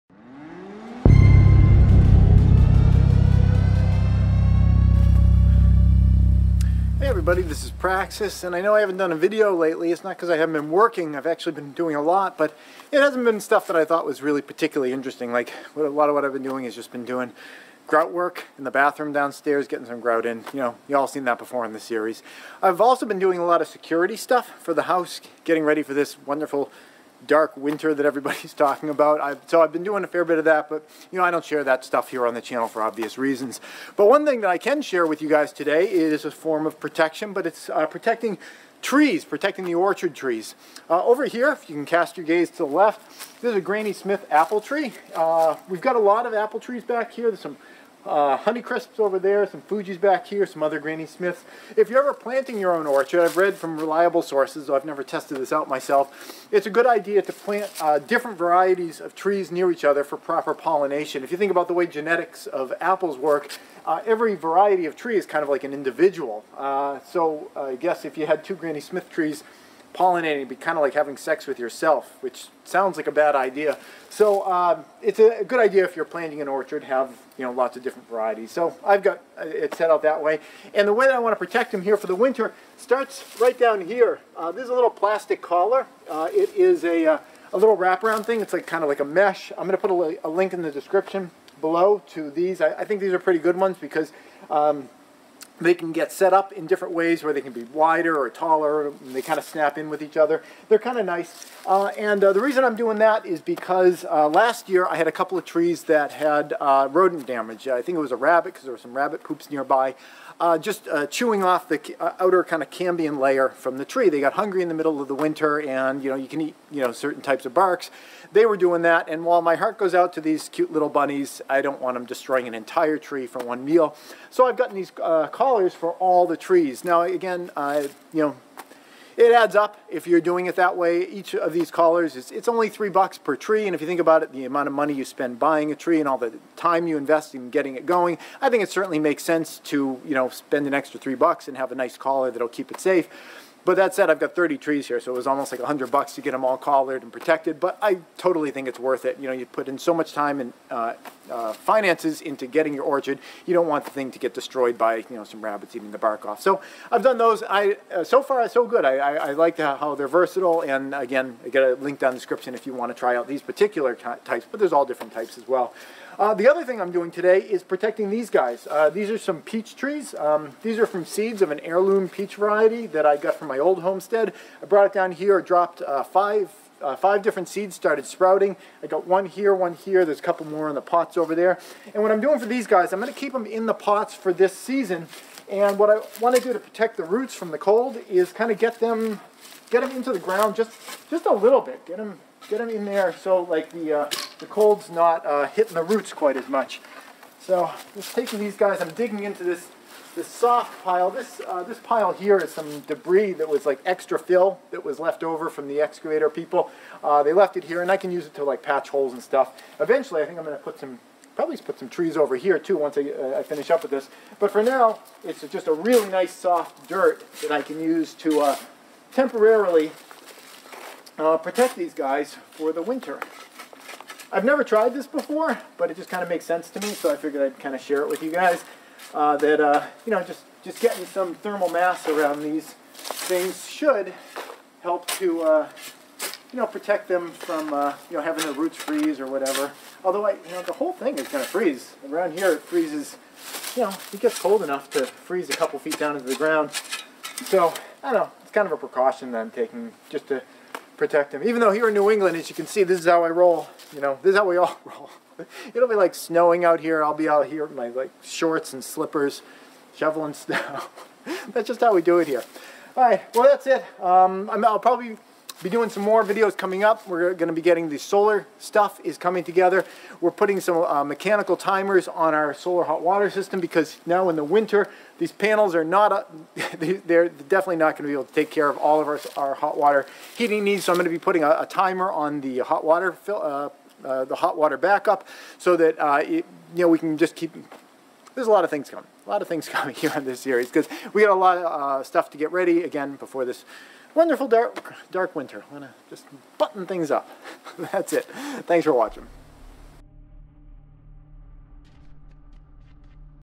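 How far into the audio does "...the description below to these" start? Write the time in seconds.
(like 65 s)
90 s.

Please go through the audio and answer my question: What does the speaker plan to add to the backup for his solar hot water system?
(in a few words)
Mechanical timers.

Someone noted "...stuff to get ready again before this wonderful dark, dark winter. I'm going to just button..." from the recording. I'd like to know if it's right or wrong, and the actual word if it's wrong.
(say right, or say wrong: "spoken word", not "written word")
right.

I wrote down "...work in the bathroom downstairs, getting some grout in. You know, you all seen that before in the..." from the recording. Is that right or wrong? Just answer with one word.
right.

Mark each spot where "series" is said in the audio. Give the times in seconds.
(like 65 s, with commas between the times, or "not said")
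21 s, 290 s.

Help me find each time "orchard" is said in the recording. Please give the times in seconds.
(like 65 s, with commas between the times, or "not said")
39 s, 52 s, 76 s, 152 s.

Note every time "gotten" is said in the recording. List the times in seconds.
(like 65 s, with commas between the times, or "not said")
124 s.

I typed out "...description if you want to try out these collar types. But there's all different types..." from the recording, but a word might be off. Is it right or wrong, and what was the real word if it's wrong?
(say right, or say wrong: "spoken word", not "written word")
wrong: "particular", not "collar".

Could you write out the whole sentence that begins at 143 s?
But that said, I've got 30 trees here, so it was almost like 100 bucks to get them all collared and protected.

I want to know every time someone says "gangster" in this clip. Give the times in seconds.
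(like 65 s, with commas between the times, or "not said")
not said.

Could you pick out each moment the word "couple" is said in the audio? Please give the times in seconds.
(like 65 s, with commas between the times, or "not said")
105 s, 180 s, 245 s.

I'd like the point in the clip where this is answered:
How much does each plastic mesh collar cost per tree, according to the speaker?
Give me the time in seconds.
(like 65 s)
132 s.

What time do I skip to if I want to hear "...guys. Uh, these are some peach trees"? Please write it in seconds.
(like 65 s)
168 s.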